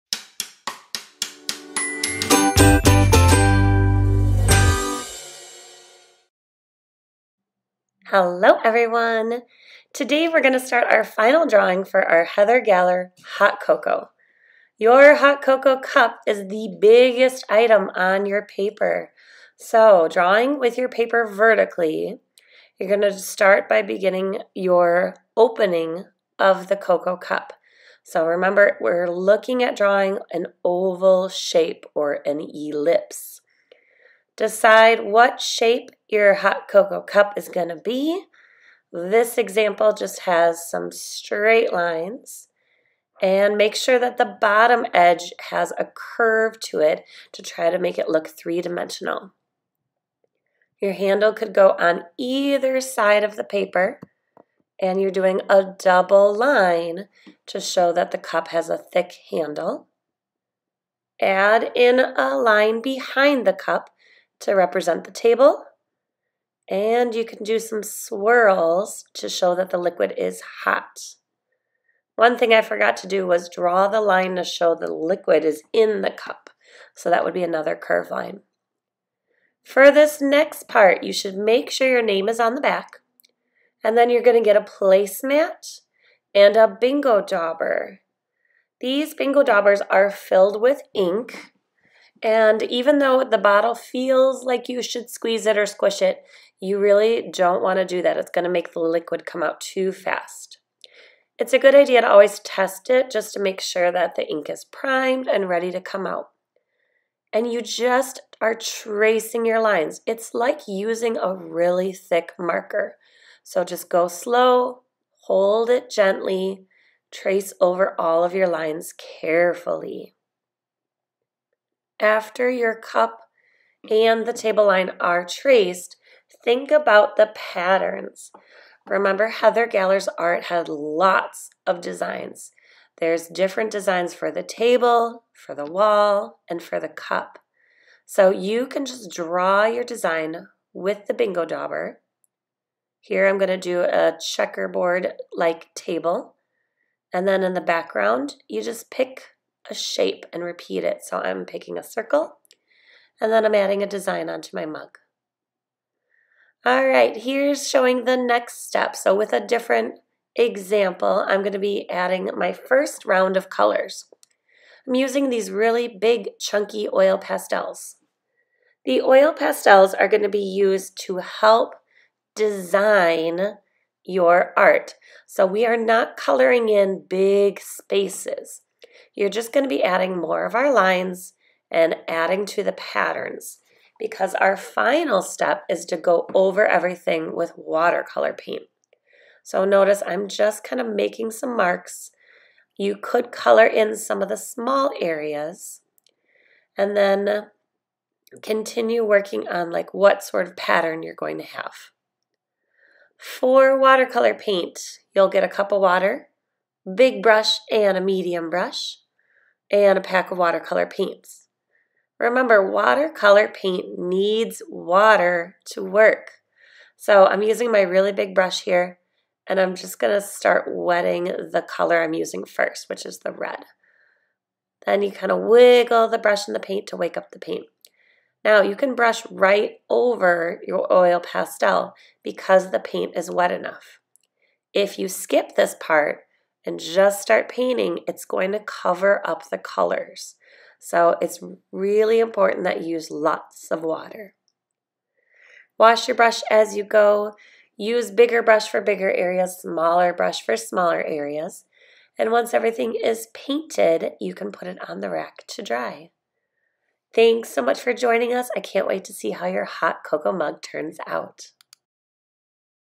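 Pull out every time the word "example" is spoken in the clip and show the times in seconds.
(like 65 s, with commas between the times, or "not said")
39 s, 160 s.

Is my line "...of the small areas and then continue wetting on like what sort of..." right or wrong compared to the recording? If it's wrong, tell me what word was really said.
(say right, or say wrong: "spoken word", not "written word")
wrong: "working", not "wetting".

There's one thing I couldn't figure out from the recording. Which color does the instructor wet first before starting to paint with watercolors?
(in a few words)
red.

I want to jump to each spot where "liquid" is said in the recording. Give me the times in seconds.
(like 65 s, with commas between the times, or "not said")
69 s, 74 s, 98 s.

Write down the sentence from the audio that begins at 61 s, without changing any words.
Add in a line behind the cup to represent the table.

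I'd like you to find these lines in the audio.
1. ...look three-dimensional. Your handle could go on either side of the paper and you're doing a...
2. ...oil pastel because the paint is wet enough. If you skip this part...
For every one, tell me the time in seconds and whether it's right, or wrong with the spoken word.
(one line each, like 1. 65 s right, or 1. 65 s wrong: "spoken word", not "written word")
1. 48 s right
2. 230 s right.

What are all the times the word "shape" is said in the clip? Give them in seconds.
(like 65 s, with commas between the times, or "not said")
31 s, 35 s, 149 s.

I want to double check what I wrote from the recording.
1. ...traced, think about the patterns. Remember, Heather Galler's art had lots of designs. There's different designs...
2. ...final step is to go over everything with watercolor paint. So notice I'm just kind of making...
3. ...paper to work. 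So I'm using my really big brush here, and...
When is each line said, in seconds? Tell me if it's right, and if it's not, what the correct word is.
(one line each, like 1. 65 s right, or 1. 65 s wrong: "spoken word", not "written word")
1. 125 s right
2. 184 s right
3. 214 s wrong: "water", not "paper".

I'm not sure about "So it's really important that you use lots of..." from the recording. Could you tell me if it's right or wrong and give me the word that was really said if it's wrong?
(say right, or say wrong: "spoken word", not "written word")
right.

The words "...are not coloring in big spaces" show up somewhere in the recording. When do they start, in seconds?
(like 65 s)
175 s.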